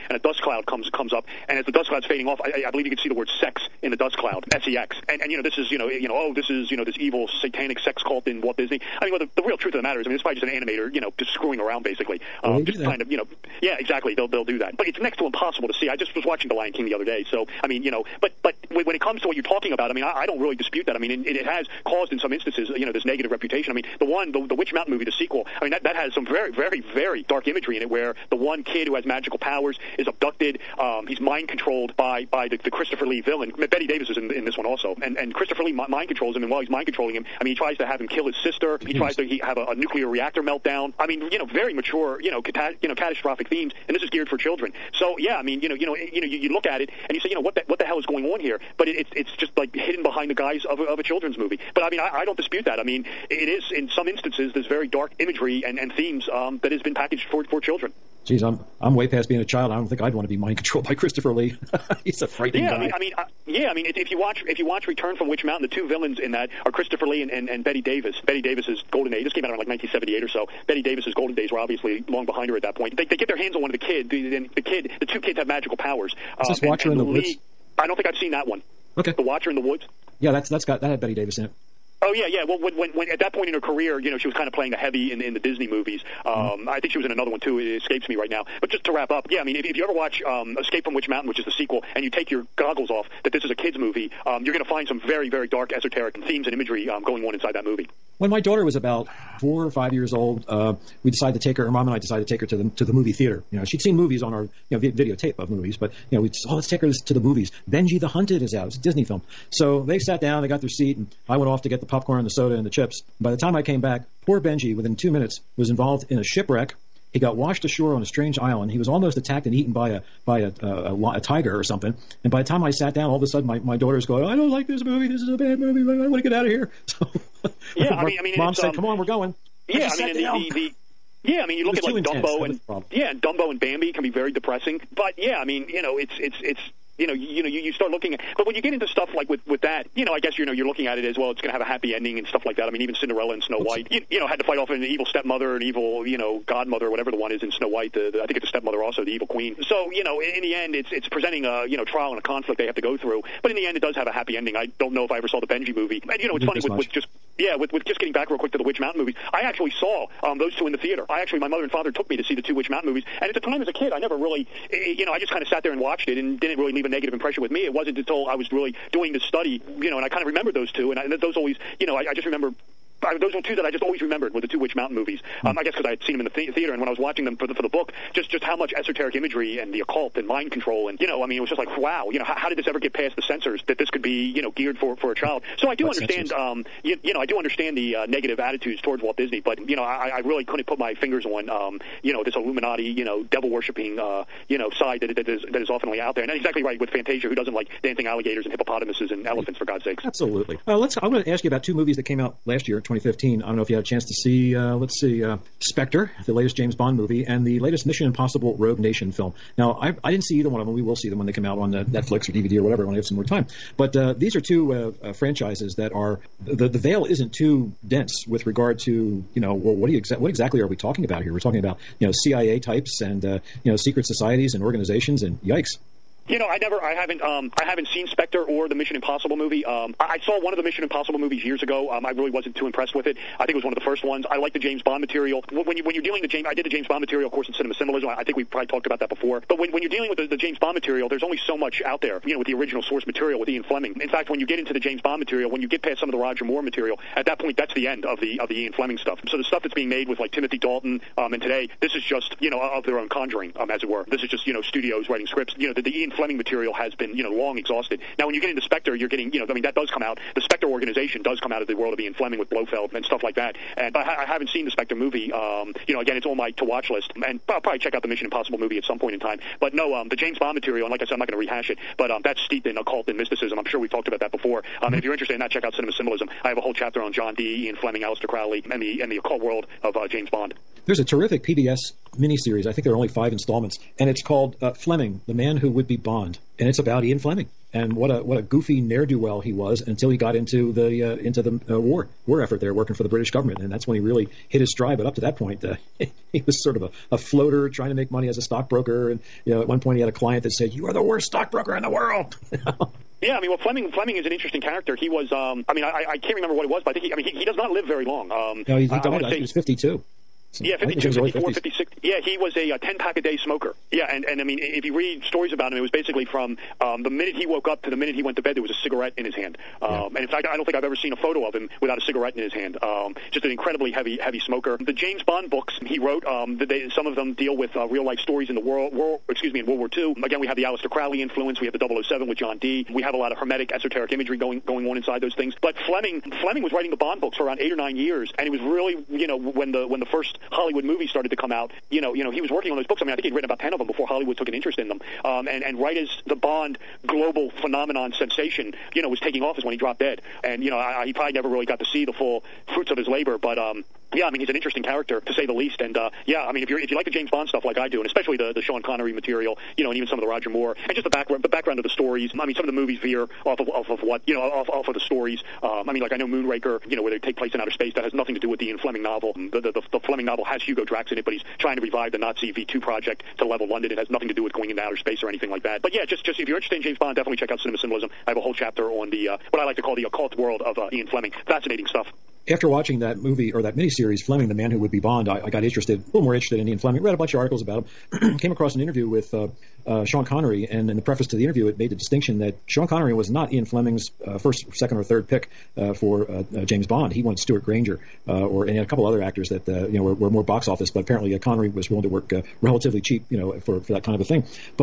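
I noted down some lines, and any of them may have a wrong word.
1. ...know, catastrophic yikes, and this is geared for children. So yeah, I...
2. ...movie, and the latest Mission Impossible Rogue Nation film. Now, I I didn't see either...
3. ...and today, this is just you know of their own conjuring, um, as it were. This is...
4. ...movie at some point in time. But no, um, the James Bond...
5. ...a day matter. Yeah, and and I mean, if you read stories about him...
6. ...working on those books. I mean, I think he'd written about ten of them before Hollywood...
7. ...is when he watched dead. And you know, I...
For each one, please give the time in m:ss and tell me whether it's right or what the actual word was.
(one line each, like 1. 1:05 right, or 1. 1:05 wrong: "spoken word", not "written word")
1. 0:42 wrong: "themes", not "yikes"
2. 3:26 right
3. 4:11 right
4. 4:28 right
5. 5:13 wrong: "smoker", not "matter"
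6. 5:42 right
7. 5:49 wrong: "dropped", not "watched".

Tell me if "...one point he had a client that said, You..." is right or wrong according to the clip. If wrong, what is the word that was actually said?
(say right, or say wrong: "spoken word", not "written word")
right.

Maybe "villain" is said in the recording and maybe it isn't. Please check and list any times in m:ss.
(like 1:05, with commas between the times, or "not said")
0:33, 1:05.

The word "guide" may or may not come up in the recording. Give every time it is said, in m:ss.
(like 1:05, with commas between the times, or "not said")
not said.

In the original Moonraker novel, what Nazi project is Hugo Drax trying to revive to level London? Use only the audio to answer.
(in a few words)
V2 project.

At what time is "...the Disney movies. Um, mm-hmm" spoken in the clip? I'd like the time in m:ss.
1:25.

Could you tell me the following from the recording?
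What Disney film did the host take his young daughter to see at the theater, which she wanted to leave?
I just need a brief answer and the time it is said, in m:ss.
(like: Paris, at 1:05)
Benji the Hunted, at 1:47.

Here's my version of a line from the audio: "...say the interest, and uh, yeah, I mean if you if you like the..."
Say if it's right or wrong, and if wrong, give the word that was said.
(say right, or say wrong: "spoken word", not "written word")
wrong: "least", not "interest".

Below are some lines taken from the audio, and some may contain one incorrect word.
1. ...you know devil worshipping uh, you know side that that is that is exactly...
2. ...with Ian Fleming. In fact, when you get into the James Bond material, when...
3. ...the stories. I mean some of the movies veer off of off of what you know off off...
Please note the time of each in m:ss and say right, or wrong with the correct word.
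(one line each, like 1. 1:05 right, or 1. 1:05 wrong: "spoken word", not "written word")
1. 3:12 wrong: "oftenly", not "exactly"
2. 4:03 right
3. 6:01 right.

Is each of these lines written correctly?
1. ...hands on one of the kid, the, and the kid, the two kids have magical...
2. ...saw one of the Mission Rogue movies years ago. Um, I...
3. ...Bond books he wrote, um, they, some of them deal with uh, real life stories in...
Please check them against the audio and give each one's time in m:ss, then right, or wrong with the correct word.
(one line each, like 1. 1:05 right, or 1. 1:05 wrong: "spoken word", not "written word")
1. 1:13 right
2. 3:50 wrong: "Impossible", not "Rogue"
3. 5:25 right.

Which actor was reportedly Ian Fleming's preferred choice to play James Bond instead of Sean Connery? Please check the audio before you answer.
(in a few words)
Stewart Granger.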